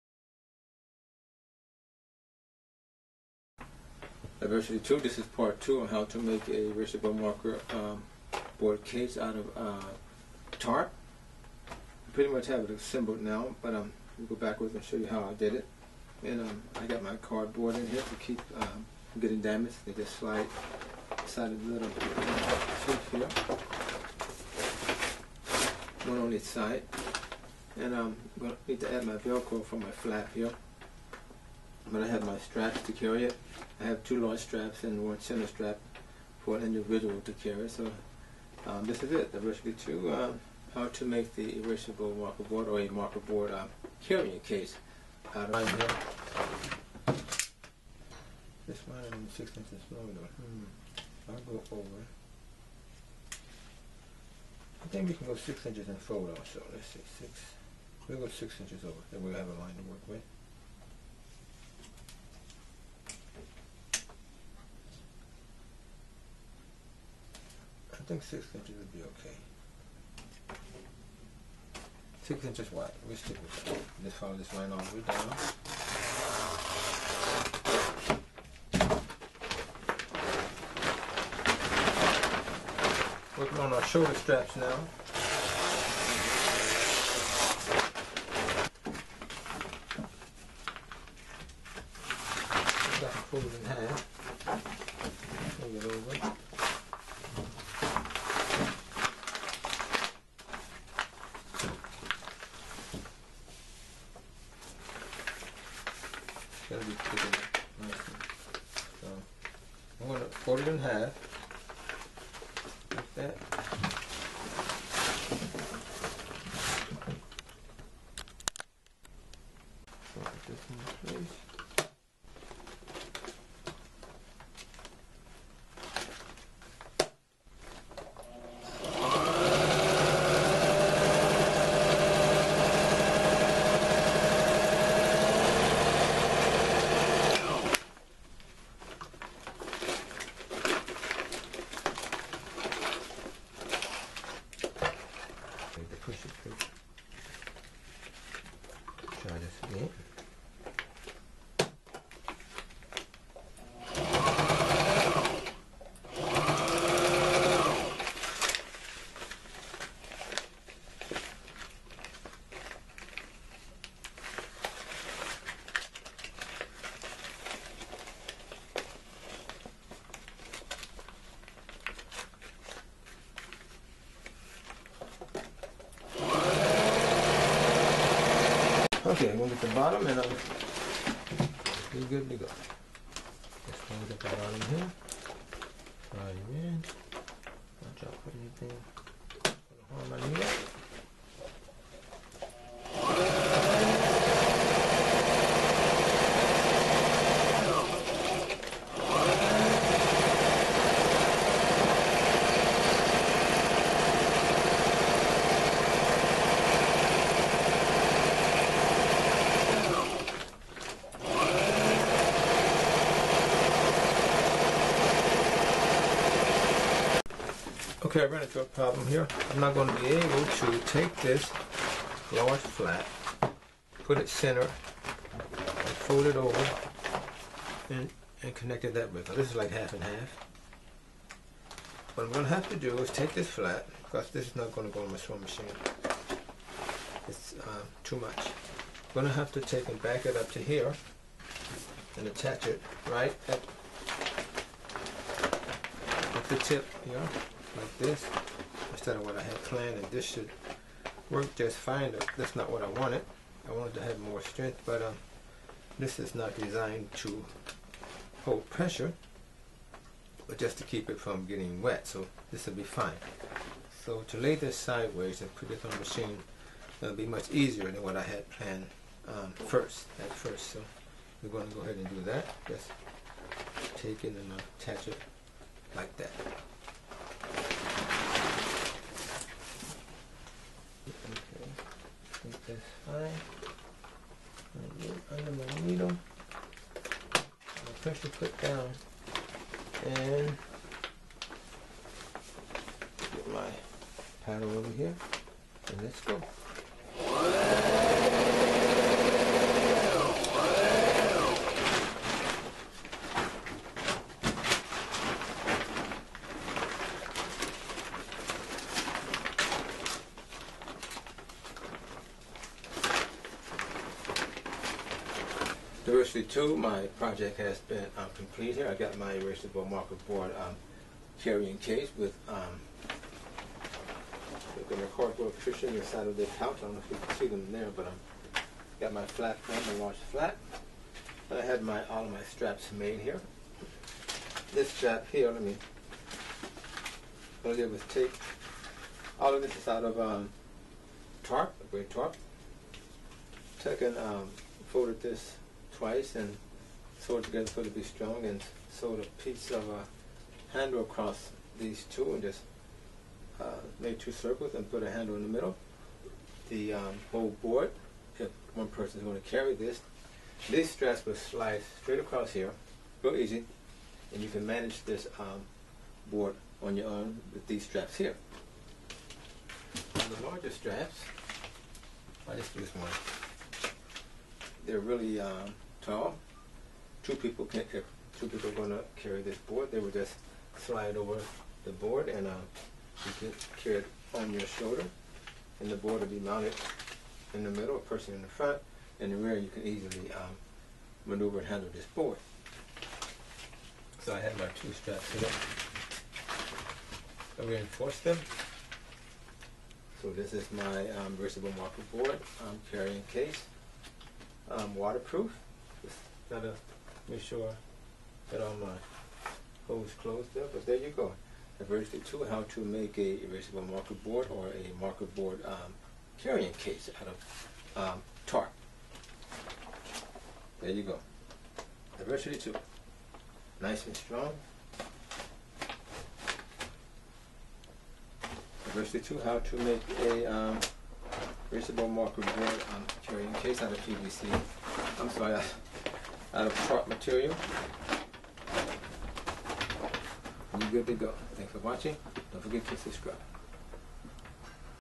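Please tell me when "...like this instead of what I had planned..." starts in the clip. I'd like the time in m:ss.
4:07.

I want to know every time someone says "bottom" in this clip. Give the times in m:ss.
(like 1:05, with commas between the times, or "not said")
2:59, 3:04.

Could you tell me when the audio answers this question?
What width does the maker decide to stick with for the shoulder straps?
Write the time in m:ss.
1:12.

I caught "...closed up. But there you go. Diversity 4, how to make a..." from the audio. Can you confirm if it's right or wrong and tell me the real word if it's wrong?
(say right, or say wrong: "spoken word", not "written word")
wrong: "2", not "4".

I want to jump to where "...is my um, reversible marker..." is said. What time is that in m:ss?
6:40.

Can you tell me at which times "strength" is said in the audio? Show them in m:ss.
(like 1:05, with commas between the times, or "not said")
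4:14.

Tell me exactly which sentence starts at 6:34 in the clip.
So I have my two straps here.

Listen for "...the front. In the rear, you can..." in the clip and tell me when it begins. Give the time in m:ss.
6:28.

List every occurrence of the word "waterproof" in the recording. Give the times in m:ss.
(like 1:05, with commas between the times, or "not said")
6:44.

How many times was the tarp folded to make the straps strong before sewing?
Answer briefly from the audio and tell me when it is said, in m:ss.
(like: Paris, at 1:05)
Twice, at 5:46.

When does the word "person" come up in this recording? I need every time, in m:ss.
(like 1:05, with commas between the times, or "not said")
5:58, 6:27.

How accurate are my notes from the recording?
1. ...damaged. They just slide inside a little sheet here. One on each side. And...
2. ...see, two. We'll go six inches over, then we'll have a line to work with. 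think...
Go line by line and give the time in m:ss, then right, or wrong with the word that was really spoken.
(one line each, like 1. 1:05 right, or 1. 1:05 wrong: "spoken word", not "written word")
1. 0:19 right
2. 0:56 wrong: "six", not "two".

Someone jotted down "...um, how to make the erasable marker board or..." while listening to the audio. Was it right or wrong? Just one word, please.
right.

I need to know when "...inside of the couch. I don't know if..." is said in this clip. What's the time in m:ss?
5:25.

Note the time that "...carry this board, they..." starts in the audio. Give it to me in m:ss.
6:19.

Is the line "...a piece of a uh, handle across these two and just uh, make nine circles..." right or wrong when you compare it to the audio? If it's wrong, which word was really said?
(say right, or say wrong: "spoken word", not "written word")
wrong: "two", not "nine".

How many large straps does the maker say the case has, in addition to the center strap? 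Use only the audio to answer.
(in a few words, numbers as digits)
2.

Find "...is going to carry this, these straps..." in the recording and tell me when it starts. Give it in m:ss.
5:59.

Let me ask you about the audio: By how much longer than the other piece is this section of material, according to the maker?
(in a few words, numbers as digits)
6 inches.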